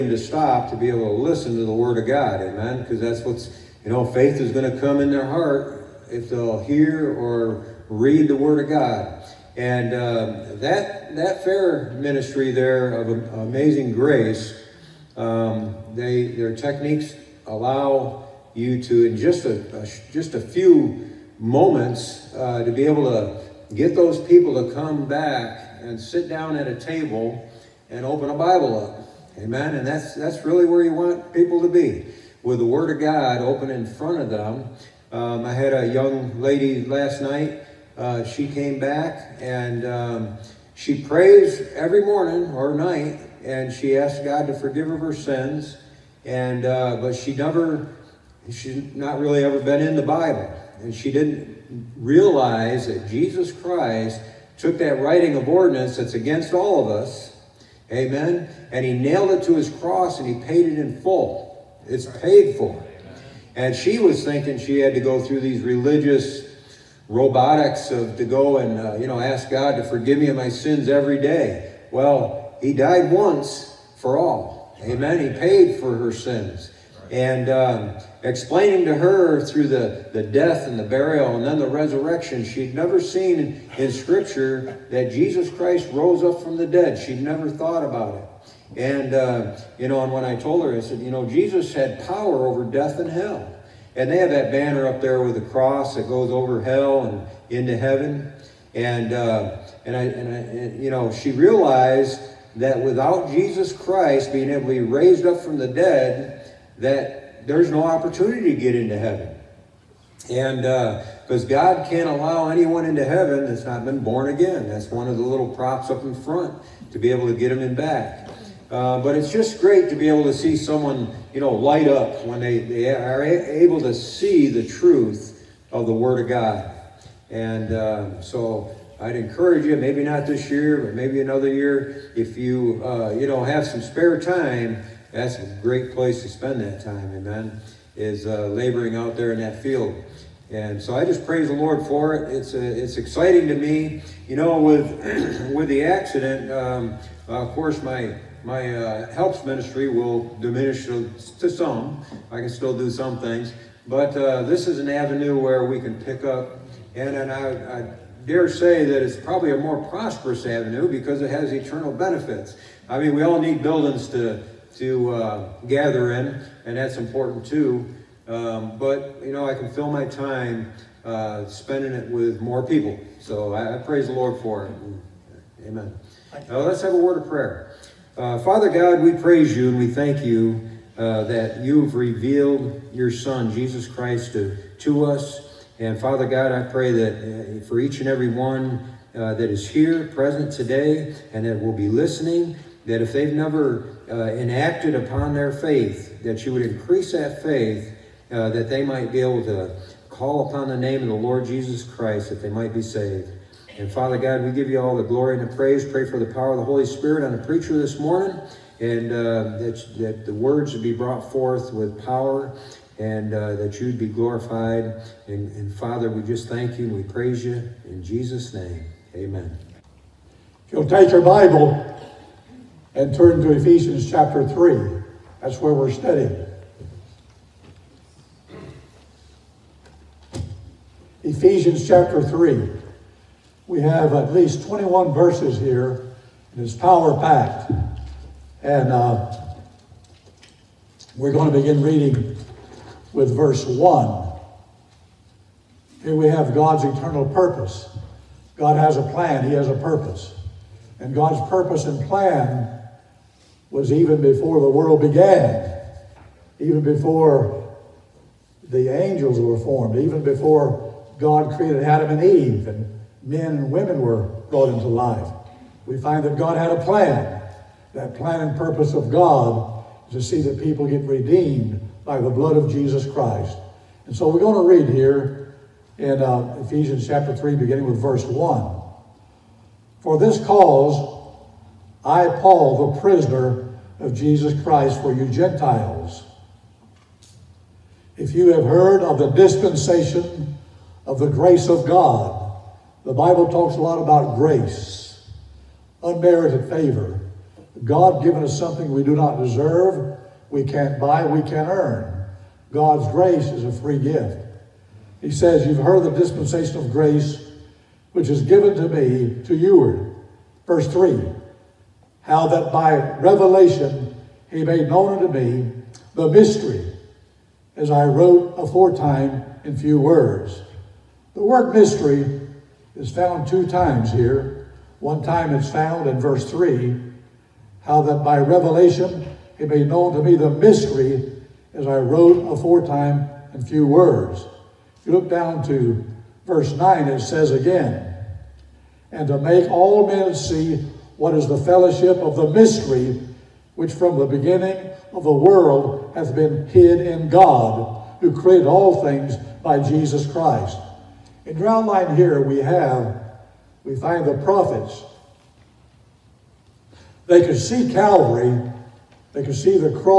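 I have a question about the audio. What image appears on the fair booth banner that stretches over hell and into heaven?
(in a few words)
the cross.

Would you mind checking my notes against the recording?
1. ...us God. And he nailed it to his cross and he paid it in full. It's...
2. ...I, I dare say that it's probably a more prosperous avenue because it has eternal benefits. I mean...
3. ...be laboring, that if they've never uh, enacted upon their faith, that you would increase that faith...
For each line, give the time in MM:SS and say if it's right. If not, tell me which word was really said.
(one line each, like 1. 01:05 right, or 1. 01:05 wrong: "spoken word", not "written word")
1. 00:57 wrong: "Amen", not "God"
2. 02:37 right
3. 03:11 wrong: "listening", not "laboring".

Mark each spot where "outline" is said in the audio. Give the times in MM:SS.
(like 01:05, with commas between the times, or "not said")
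05:51.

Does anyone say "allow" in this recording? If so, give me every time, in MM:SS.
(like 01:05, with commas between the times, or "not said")
00:17, 01:52.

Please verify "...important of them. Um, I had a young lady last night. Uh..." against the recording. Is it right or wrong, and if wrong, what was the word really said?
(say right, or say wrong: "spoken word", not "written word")
wrong: "front", not "important".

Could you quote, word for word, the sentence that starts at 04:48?
If you have heard of the dispensation of the grace of God, the Bible talks a lot about grace, unmerited favor.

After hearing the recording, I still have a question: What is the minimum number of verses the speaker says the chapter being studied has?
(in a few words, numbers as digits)
21.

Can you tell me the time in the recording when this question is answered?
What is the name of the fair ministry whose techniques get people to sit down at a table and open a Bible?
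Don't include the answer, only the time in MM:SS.
00:13.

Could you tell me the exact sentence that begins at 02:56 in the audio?
Uh, let's have a word of prayer.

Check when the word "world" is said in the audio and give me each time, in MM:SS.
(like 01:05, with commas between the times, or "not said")
04:14, 05:45.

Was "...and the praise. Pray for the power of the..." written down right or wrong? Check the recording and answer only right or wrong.
right.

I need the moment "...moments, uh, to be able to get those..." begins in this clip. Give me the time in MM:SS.
00:21.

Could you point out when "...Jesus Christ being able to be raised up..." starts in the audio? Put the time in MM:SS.
01:43.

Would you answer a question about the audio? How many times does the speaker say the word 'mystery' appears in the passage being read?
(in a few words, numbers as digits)
2.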